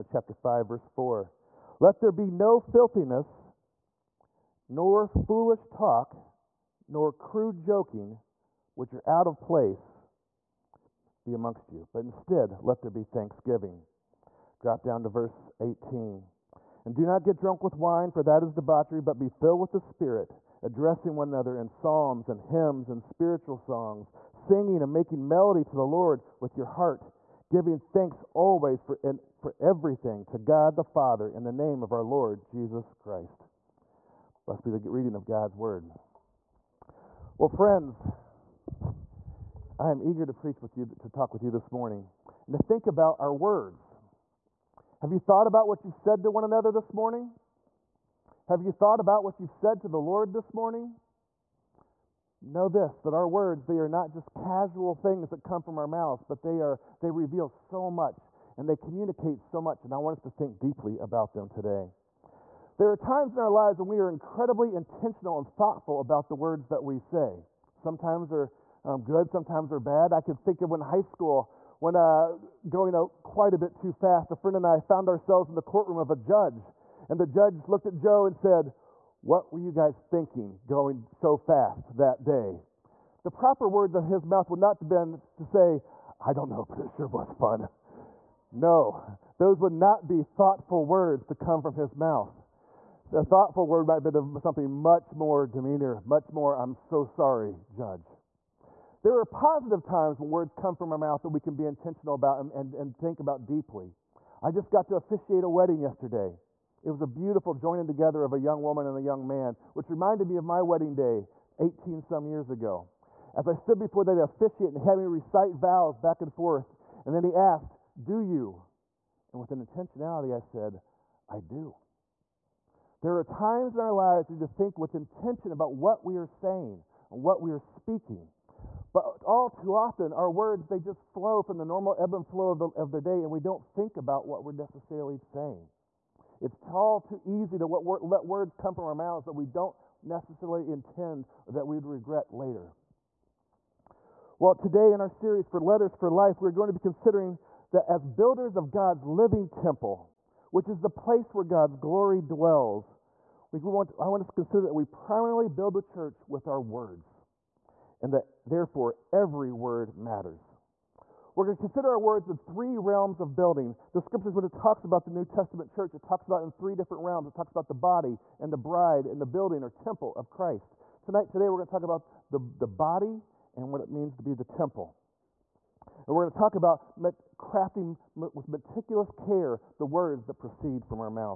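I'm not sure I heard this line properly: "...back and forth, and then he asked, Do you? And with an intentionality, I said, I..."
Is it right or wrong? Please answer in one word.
right.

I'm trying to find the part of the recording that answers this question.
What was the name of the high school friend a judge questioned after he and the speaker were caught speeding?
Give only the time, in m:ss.
1:17.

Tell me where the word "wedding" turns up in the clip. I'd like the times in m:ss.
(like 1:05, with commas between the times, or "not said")
1:45, 1:50.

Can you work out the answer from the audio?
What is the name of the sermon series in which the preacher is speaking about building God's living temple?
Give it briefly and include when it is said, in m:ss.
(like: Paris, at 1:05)
Letters for Life, at 2:25.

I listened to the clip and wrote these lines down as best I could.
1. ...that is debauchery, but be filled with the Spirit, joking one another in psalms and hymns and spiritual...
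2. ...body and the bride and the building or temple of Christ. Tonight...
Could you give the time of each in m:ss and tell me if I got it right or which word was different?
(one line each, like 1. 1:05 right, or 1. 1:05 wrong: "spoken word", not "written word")
1. 0:18 wrong: "addressing", not "joking"
2. 2:47 right.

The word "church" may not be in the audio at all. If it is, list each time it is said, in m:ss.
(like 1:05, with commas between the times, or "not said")
2:35, 2:45.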